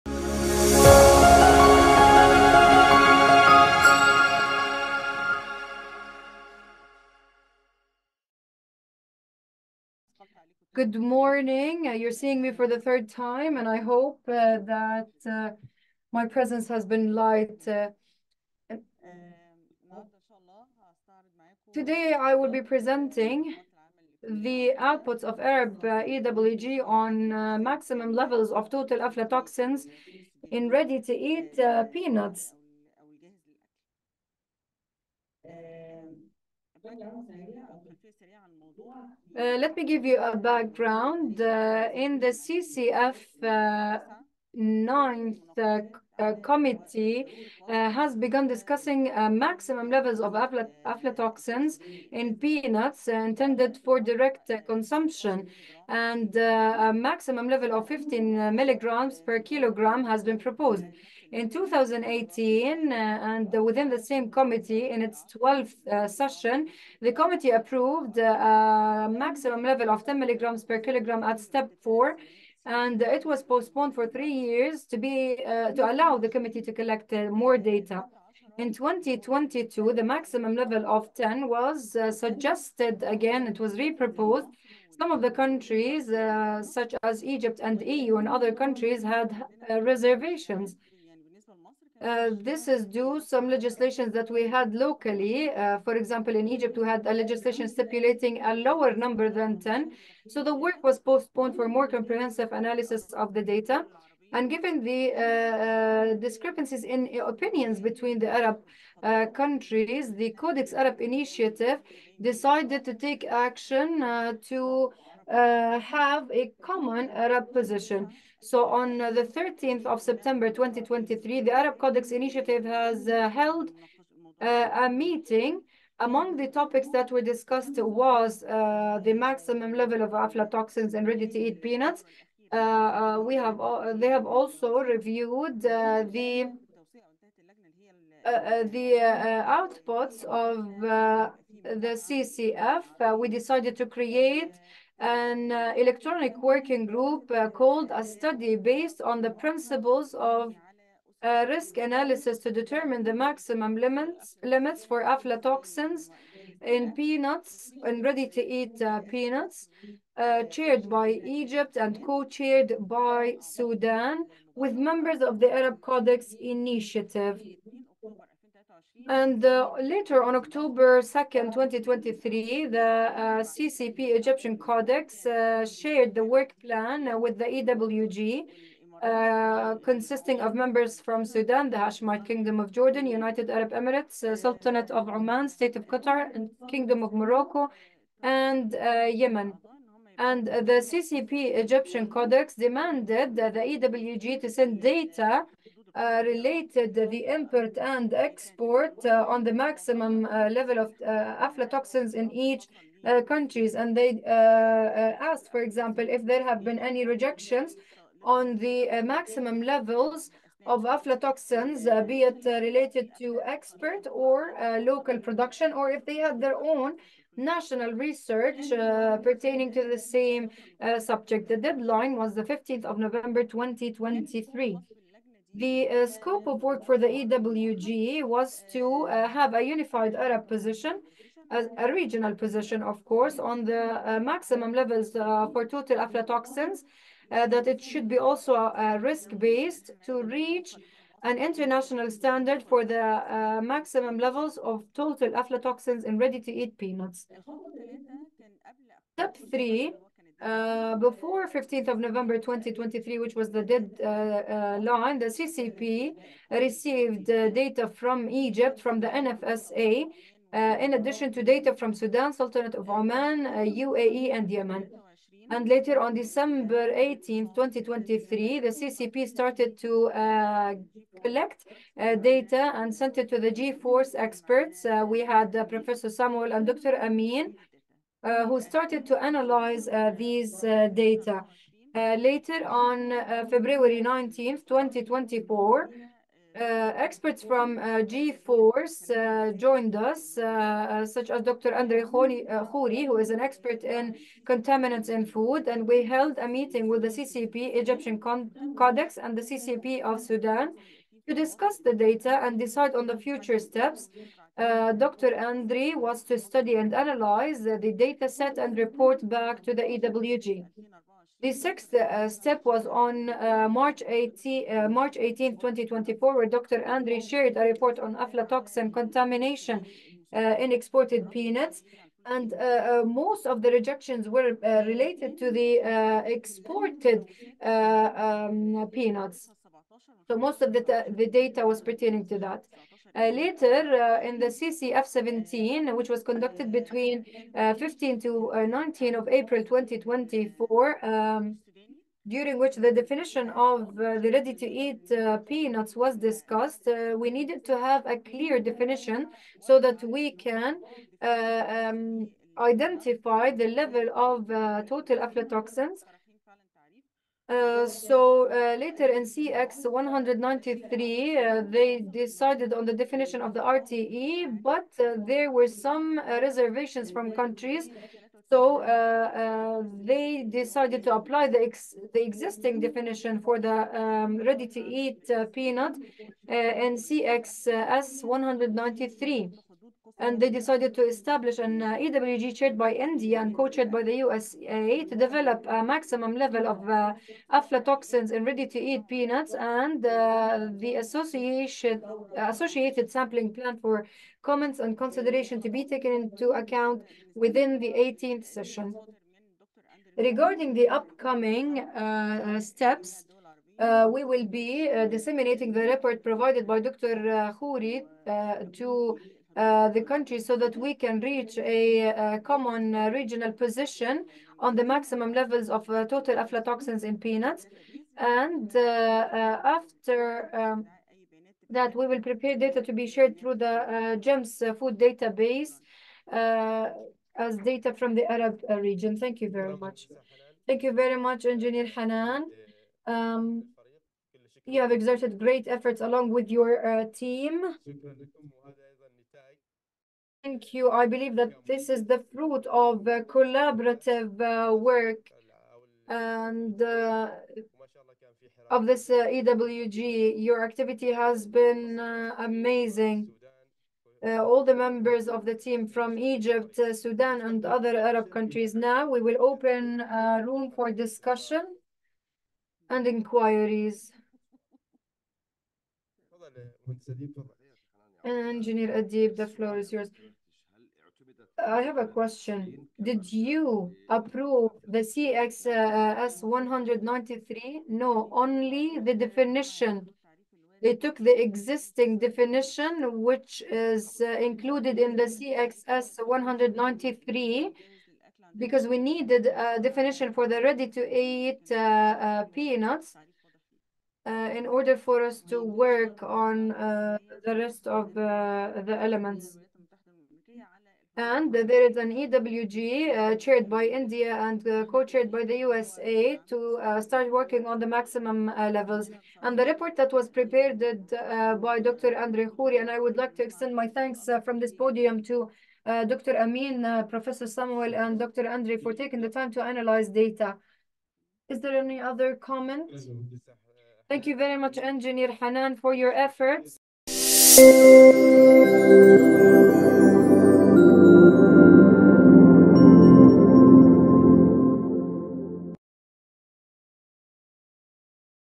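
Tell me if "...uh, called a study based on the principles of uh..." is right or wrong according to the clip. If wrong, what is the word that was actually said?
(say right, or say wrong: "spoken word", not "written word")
right.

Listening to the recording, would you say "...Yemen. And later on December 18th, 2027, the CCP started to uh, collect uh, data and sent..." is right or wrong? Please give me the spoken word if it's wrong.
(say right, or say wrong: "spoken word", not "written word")
wrong: "2023", not "2027".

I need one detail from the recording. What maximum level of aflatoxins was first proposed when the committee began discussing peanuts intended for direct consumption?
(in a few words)
15 milligrams per kilogram.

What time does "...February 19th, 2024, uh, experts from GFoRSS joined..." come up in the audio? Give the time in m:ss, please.
4:43.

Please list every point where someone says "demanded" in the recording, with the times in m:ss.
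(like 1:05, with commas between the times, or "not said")
3:12.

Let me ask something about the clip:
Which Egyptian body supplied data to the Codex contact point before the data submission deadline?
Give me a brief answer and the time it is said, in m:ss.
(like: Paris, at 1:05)
NFSA, at 4:19.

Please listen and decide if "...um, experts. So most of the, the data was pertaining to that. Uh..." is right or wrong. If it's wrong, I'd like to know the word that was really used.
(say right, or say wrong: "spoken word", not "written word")
wrong: "peanuts", not "experts".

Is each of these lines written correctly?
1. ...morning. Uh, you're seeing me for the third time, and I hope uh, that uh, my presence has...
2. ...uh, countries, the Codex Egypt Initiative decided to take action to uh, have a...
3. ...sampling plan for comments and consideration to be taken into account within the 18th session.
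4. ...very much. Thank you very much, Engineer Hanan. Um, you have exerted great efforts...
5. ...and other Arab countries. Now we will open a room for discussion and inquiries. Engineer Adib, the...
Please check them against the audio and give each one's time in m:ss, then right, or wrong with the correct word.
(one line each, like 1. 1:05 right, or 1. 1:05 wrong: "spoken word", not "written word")
1. 0:10 right
2. 1:49 wrong: "Arab", not "Egypt"
3. 6:33 right
4. 7:09 right
5. 7:37 right.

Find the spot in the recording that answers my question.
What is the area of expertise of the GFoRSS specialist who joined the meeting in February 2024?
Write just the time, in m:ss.
4:54.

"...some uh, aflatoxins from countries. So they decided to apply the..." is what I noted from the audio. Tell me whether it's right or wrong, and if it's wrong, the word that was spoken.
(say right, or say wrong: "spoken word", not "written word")
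wrong: "reservations", not "aflatoxins".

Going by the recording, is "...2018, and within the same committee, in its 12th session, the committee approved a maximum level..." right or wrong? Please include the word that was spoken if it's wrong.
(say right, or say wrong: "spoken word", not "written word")
right.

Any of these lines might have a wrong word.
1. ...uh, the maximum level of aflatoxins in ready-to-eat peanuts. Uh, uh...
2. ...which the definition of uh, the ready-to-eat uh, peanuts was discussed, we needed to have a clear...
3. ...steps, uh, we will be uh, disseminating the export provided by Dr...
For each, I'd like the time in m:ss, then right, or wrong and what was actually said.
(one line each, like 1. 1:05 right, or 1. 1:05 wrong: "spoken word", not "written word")
1. 2:08 right
2. 5:42 right
3. 6:42 wrong: "report", not "export".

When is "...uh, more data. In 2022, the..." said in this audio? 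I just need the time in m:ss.
1:17.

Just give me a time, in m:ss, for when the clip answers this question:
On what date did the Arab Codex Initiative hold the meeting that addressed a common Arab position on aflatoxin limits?
1:59.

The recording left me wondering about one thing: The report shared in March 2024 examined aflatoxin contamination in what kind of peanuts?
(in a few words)
Exported peanuts.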